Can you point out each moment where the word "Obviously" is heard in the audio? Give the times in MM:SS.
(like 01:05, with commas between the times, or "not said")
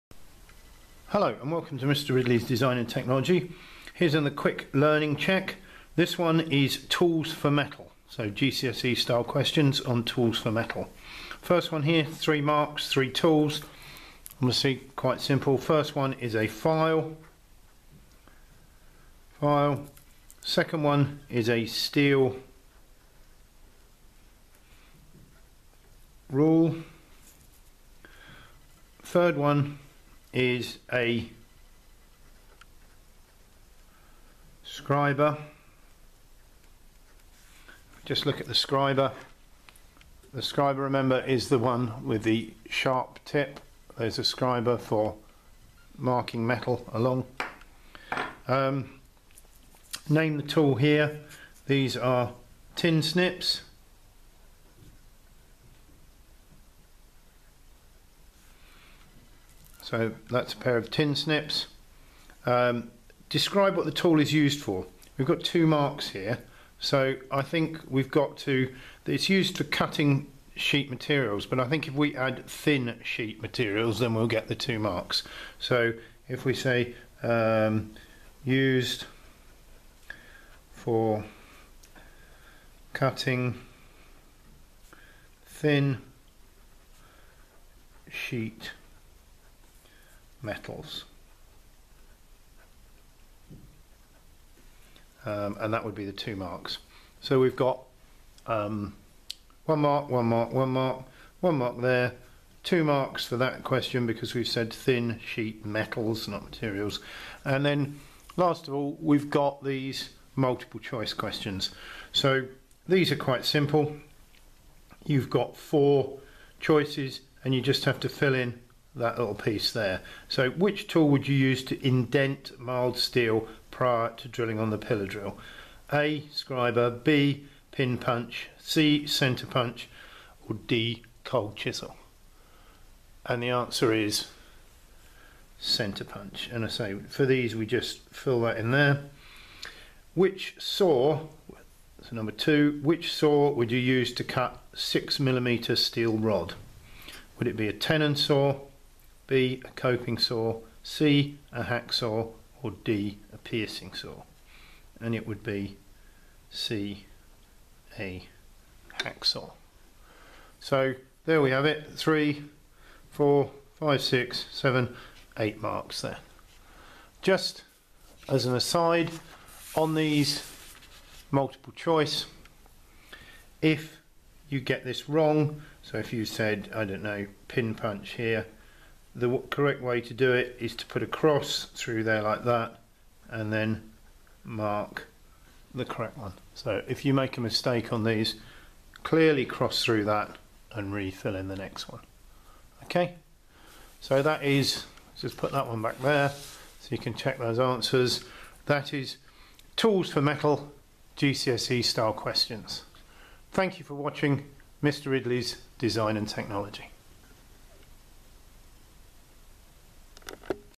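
00:14.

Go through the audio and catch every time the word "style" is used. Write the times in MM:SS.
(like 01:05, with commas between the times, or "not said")
00:08, 03:21.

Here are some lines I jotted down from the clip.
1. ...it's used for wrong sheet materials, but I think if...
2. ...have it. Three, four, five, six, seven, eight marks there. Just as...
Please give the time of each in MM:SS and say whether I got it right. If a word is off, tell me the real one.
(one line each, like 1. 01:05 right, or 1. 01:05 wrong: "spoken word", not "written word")
1. 01:09 wrong: "cutting", not "wrong"
2. 02:41 right.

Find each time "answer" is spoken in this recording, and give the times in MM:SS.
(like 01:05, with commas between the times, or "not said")
02:13, 03:17.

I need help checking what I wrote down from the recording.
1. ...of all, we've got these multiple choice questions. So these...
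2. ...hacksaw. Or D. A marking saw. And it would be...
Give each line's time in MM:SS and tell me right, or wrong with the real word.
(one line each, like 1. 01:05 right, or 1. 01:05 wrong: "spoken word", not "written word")
1. 01:48 right
2. 02:31 wrong: "piercing", not "marking".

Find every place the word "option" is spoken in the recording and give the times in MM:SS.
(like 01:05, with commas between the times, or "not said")
not said.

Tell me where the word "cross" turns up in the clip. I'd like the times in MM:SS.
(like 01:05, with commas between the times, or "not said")
03:01, 03:09.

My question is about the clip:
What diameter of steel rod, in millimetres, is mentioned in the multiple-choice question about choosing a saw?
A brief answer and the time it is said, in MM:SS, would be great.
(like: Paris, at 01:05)
6, at 02:24.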